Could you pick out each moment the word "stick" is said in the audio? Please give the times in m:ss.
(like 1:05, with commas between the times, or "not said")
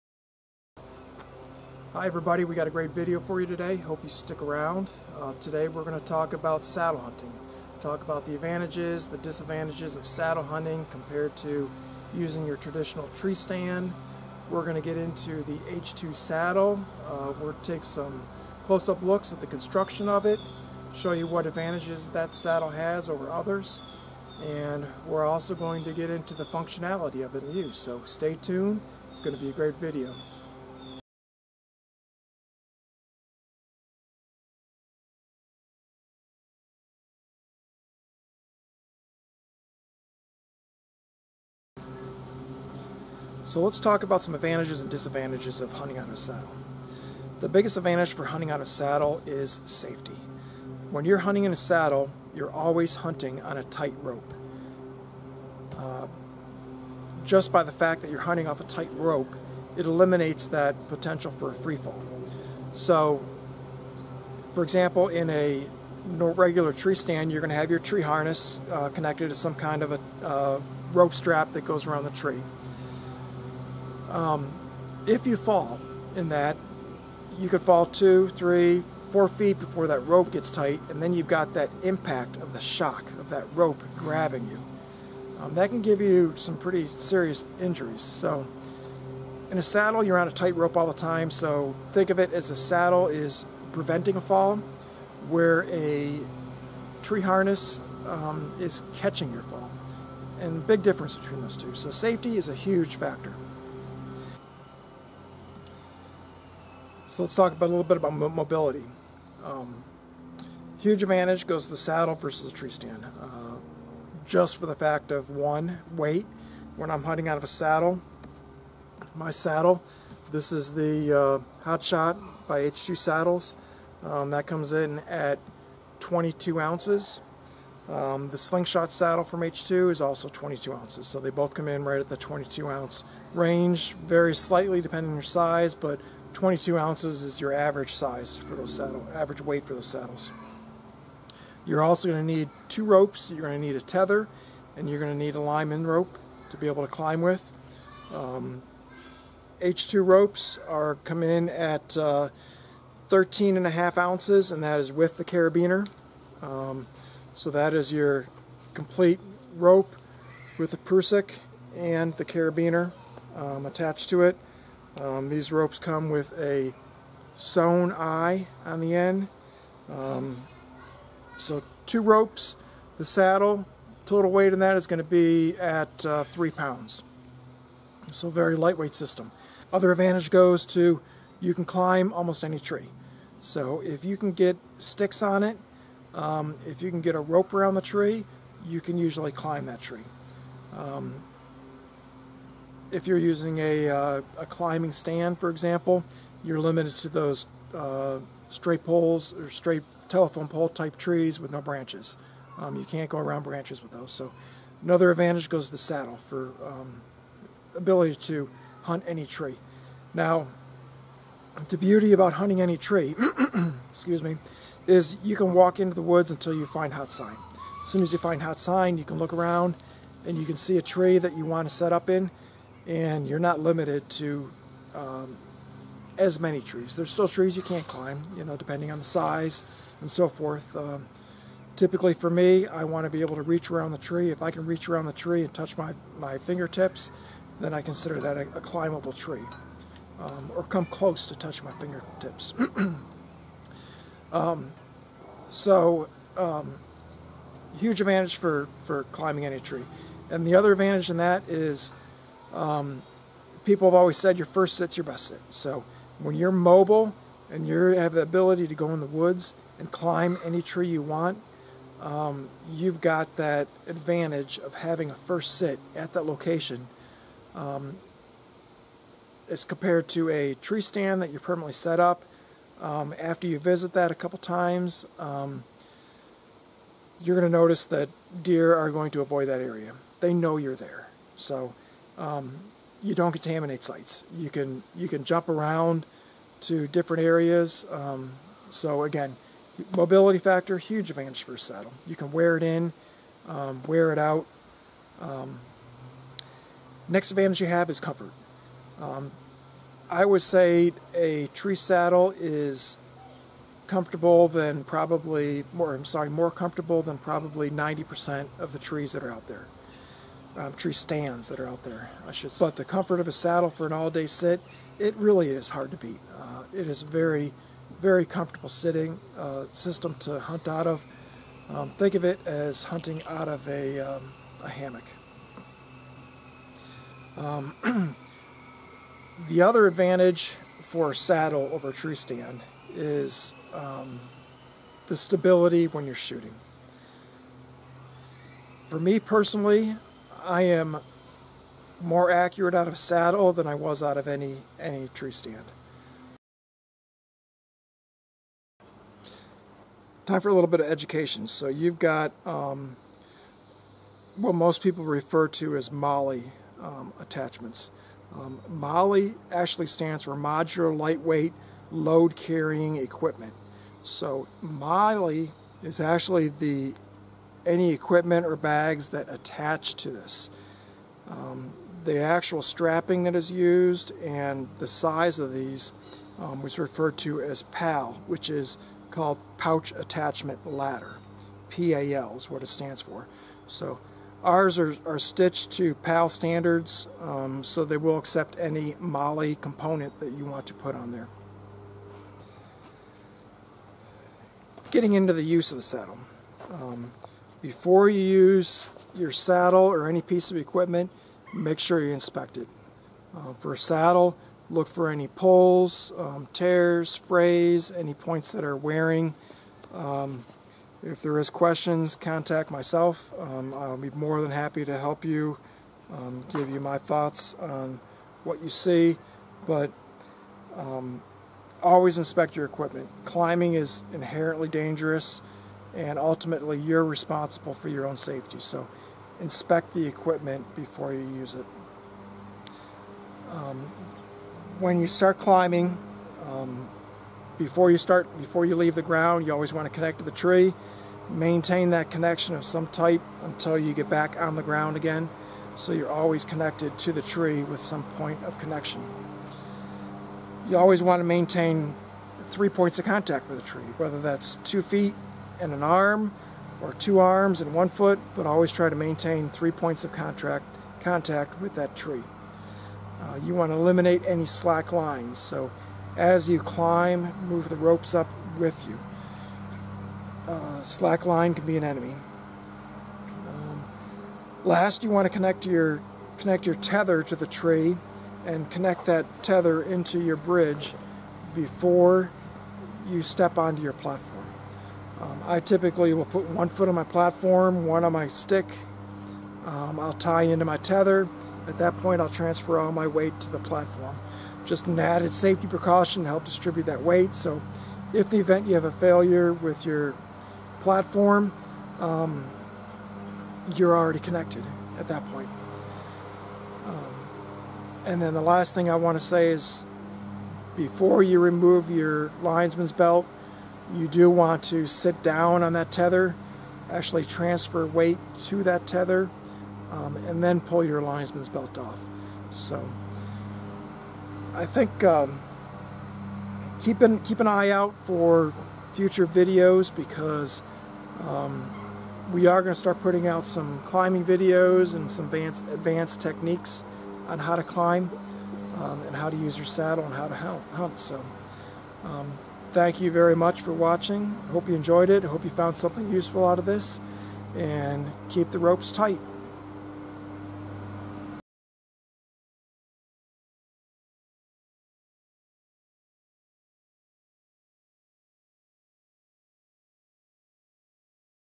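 0:04, 3:04, 8:08.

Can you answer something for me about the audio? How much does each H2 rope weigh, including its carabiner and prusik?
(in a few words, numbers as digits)
13.5 ounces.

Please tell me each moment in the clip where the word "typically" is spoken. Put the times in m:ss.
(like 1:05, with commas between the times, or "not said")
3:51, 8:05.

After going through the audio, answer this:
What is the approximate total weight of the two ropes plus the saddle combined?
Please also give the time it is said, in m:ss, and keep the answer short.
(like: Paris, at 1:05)
3 pounds, at 2:56.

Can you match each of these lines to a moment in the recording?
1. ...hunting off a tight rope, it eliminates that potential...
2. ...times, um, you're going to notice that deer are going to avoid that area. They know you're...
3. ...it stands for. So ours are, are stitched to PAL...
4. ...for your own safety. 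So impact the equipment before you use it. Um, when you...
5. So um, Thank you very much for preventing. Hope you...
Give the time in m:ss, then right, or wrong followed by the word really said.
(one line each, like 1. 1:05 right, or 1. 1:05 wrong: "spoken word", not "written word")
1. 0:58 right
2. 4:34 right
3. 6:22 right
4. 7:07 wrong: "inspect", not "impact"
5. 9:00 wrong: "watching", not "preventing".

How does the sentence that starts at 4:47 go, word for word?
Um, so again, mobility factor huge advantage for a saddle.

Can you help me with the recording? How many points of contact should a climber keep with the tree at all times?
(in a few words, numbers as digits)
3.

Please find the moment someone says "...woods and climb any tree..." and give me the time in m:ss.
4:19.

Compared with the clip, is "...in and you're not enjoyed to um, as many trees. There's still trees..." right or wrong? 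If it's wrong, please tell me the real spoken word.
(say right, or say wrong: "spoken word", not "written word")
wrong: "limited", not "enjoyed".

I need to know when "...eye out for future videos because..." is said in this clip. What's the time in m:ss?
8:47.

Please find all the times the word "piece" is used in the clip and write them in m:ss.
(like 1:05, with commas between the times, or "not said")
6:40.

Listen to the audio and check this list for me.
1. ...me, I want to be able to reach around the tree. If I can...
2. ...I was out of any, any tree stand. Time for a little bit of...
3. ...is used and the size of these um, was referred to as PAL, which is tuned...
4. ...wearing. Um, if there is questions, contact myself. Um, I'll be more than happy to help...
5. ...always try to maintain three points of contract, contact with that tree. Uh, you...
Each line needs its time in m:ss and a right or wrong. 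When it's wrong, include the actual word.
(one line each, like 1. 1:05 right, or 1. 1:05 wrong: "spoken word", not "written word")
1. 3:52 right
2. 5:43 right
3. 6:13 wrong: "called", not "tuned"
4. 6:48 right
5. 7:38 right.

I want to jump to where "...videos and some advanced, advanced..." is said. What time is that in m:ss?
8:54.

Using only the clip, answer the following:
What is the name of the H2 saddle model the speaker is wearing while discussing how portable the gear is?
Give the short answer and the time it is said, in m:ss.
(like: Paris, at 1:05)
Hot Shot, at 2:01.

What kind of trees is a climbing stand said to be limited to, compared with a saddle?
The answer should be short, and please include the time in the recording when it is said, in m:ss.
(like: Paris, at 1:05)
telephone pole type trees, at 3:20.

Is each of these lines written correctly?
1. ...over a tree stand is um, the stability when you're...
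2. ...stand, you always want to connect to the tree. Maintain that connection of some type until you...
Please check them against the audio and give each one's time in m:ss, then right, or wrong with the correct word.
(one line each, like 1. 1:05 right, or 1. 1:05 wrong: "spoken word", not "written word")
1. 5:31 right
2. 7:19 wrong: "ground", not "stand".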